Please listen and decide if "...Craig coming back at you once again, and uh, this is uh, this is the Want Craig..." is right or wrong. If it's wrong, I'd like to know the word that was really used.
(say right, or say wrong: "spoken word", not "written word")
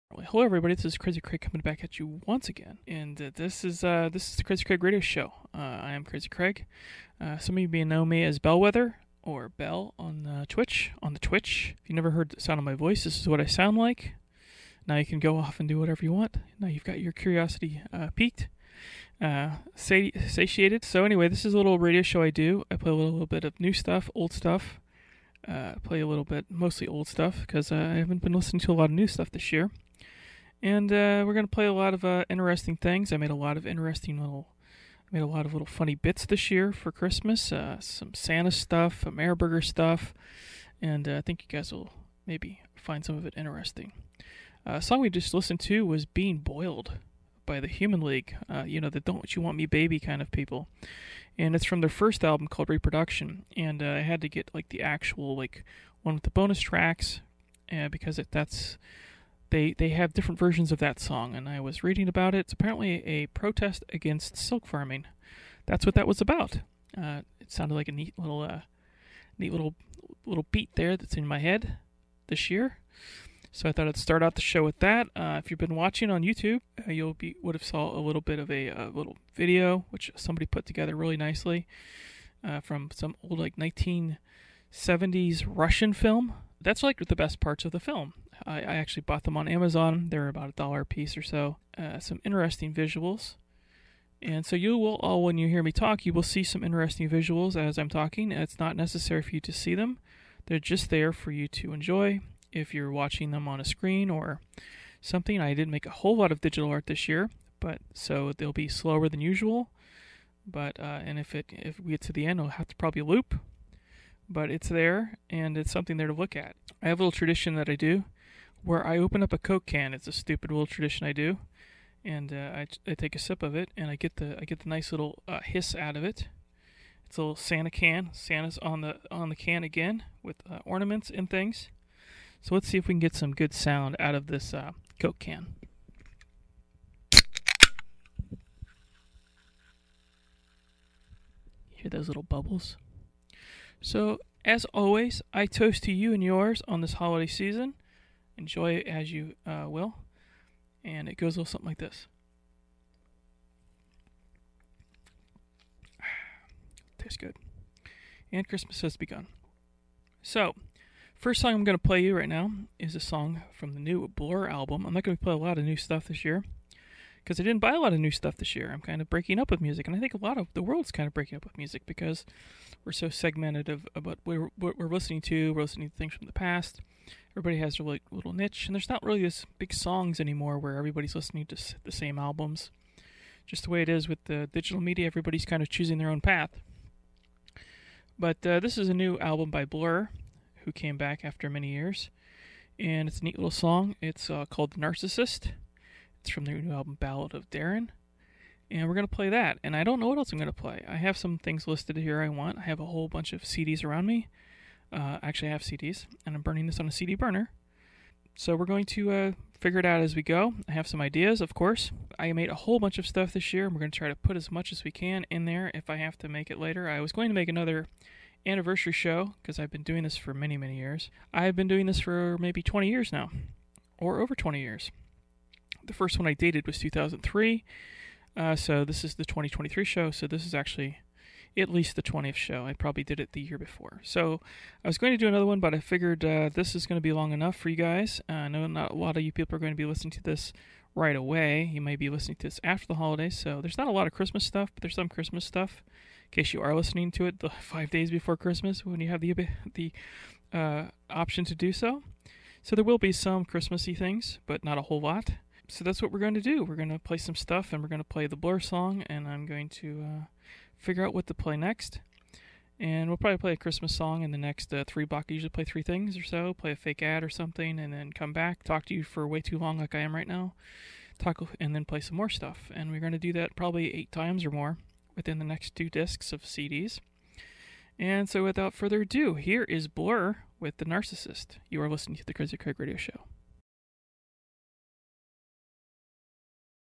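wrong: "Crazy", not "Want".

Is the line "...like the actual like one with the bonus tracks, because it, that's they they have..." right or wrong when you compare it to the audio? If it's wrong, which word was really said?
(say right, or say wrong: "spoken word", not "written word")
right.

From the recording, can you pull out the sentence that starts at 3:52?
I probably did it the year before.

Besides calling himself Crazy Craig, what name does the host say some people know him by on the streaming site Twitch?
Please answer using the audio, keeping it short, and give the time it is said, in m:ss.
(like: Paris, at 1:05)
Bellwether, at 0:08.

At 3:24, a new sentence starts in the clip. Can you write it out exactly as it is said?
Uh, actually, I have CDs, and I'm burning this on a CD burner.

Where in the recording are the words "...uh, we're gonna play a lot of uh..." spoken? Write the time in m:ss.
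0:30.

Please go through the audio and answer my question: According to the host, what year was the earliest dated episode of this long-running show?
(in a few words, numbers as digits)
2003.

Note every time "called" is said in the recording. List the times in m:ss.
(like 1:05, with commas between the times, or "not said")
0:52, 3:14.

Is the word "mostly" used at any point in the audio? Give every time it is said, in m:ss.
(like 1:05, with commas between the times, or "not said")
0:26.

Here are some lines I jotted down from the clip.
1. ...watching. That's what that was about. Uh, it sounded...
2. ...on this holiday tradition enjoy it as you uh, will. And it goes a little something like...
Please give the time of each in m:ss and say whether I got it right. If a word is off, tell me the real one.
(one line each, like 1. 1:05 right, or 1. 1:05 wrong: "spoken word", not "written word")
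1. 1:04 wrong: "farming", not "watching"
2. 2:26 wrong: "season", not "tradition".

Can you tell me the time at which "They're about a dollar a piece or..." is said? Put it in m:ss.
1:30.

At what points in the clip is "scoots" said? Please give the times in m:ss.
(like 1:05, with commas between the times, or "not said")
not said.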